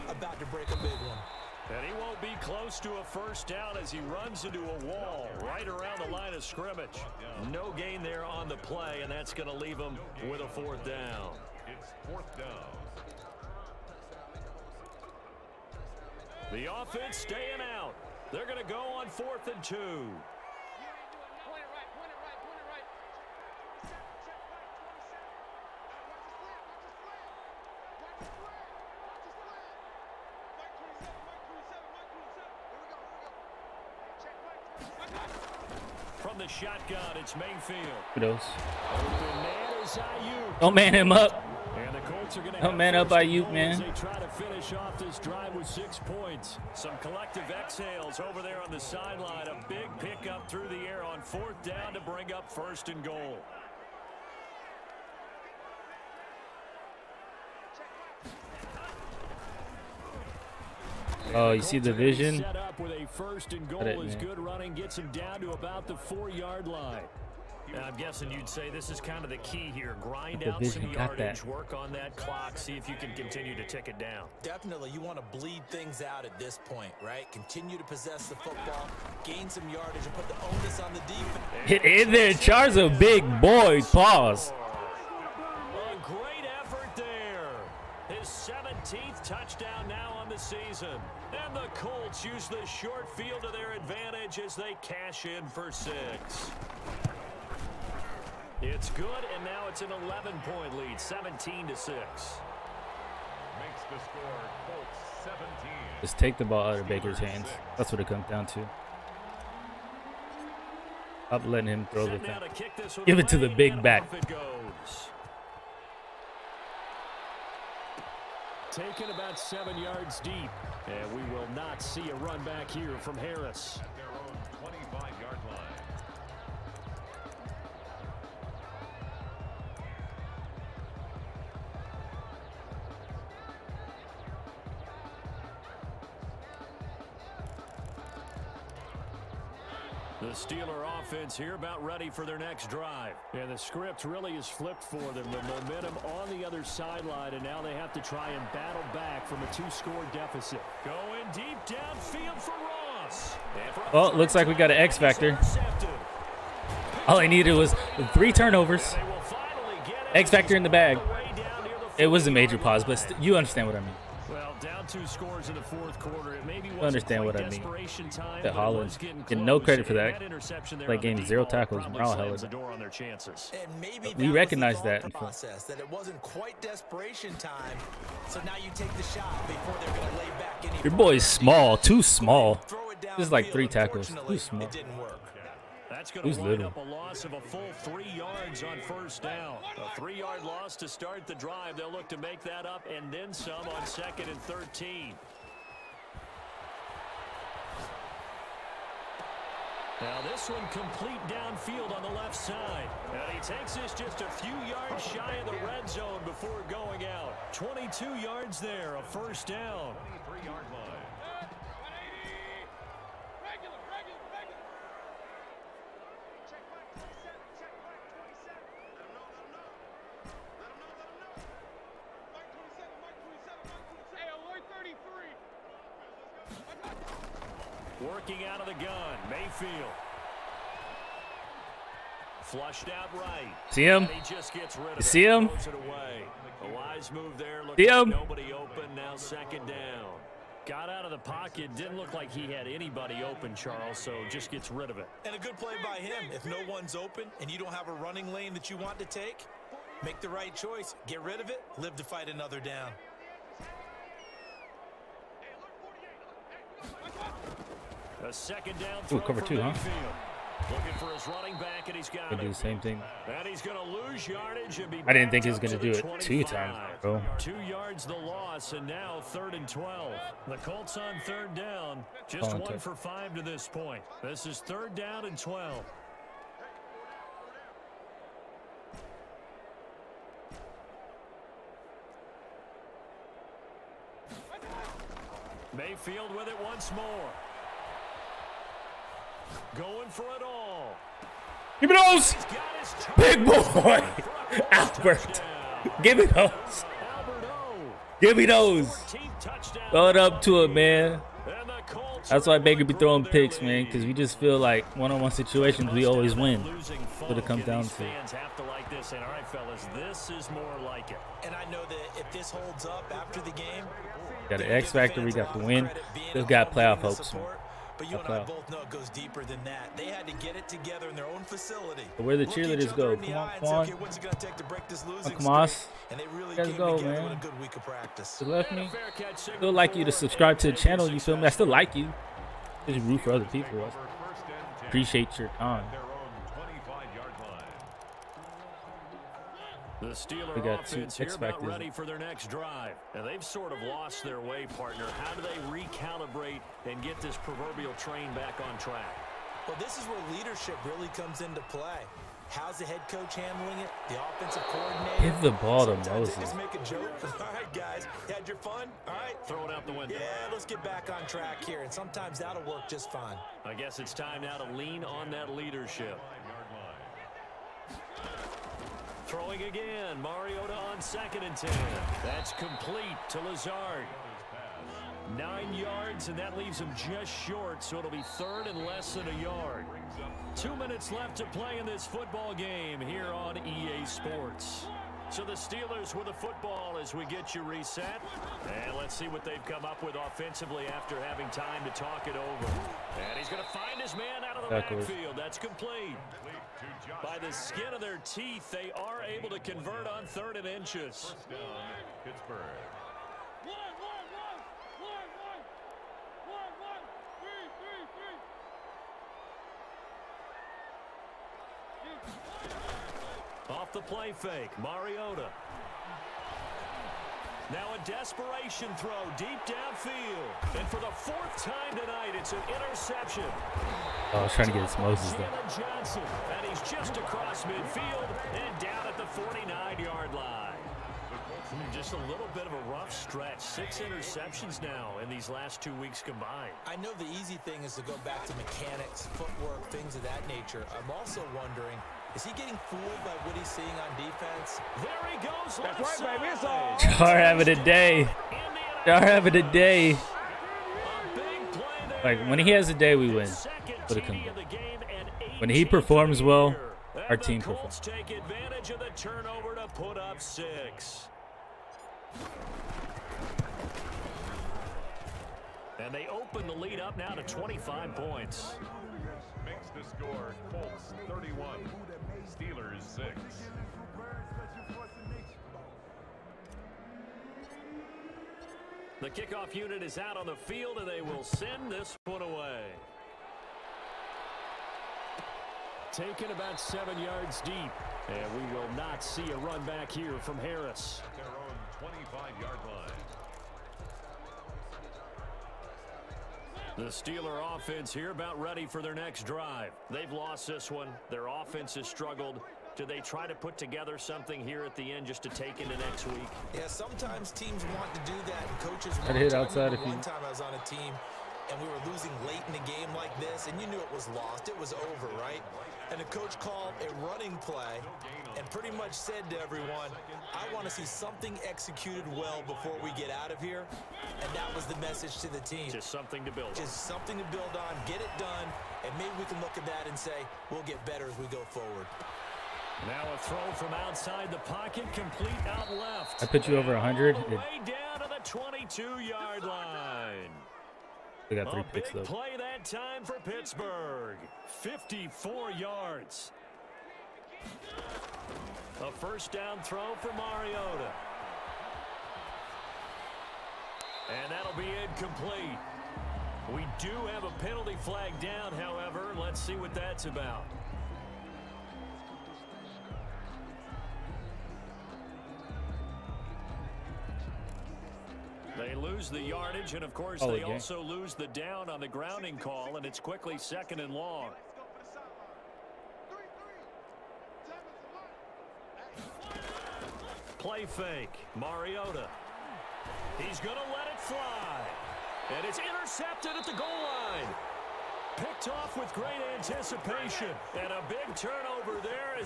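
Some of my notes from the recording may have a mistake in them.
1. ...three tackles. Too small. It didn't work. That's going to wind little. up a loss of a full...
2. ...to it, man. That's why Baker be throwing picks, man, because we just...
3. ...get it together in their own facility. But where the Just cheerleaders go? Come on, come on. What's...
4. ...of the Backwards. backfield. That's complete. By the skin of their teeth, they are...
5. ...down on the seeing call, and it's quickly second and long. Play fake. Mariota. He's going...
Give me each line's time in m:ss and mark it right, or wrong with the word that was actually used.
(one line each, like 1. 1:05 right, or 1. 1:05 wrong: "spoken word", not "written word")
1. 3:03 right
2. 5:00 right
3. 5:20 wrong: "Look", not "Just"
4. 6:34 right
5. 9:31 wrong: "grounding", not "seeing".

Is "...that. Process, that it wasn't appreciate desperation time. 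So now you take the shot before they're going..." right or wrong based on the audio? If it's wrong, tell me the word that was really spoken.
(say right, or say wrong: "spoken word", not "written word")
wrong: "quite", not "appreciate".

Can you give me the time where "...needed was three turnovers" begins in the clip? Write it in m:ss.
2:37.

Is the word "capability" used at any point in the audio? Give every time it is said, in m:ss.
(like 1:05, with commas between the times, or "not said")
not said.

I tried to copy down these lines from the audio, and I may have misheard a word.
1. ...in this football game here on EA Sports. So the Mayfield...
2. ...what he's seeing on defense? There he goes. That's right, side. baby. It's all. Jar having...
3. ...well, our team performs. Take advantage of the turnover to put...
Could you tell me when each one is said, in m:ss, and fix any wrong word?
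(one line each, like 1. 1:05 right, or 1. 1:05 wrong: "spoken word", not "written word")
1. 6:21 wrong: "Steelers", not "Mayfield"
2. 7:23 right
3. 7:36 right.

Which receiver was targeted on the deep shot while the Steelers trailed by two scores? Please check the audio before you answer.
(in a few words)
Ross.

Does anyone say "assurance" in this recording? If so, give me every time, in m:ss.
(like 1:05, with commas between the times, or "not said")
not said.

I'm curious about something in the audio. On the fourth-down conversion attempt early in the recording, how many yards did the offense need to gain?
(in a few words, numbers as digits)
2.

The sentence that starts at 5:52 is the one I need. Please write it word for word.
How's the head coach handling it?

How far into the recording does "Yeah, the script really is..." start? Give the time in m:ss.
2:23.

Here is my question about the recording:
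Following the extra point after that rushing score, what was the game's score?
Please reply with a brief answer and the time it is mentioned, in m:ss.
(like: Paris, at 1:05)
17 to 6, at 1:40.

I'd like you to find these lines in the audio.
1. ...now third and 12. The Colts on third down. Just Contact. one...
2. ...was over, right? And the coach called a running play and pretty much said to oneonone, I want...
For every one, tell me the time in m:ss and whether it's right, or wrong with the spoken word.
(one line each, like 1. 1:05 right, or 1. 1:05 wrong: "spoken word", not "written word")
1. 4:28 right
2. 8:34 wrong: "everyone", not "oneonone".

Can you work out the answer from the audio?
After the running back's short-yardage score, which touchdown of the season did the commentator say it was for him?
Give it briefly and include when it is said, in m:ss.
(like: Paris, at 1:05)
17th, at 1:28.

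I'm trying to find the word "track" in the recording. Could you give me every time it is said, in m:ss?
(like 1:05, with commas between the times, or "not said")
5:48, 6:01.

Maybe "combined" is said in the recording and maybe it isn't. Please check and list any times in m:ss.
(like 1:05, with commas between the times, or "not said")
7:16.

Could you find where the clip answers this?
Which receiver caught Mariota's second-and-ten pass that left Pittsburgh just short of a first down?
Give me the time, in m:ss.
6:13.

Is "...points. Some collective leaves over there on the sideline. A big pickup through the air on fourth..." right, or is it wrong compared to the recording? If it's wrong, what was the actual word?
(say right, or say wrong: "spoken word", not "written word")
wrong: "exhales", not "leaves".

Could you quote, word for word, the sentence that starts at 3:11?
They'll look to make that up and then some on second and 13.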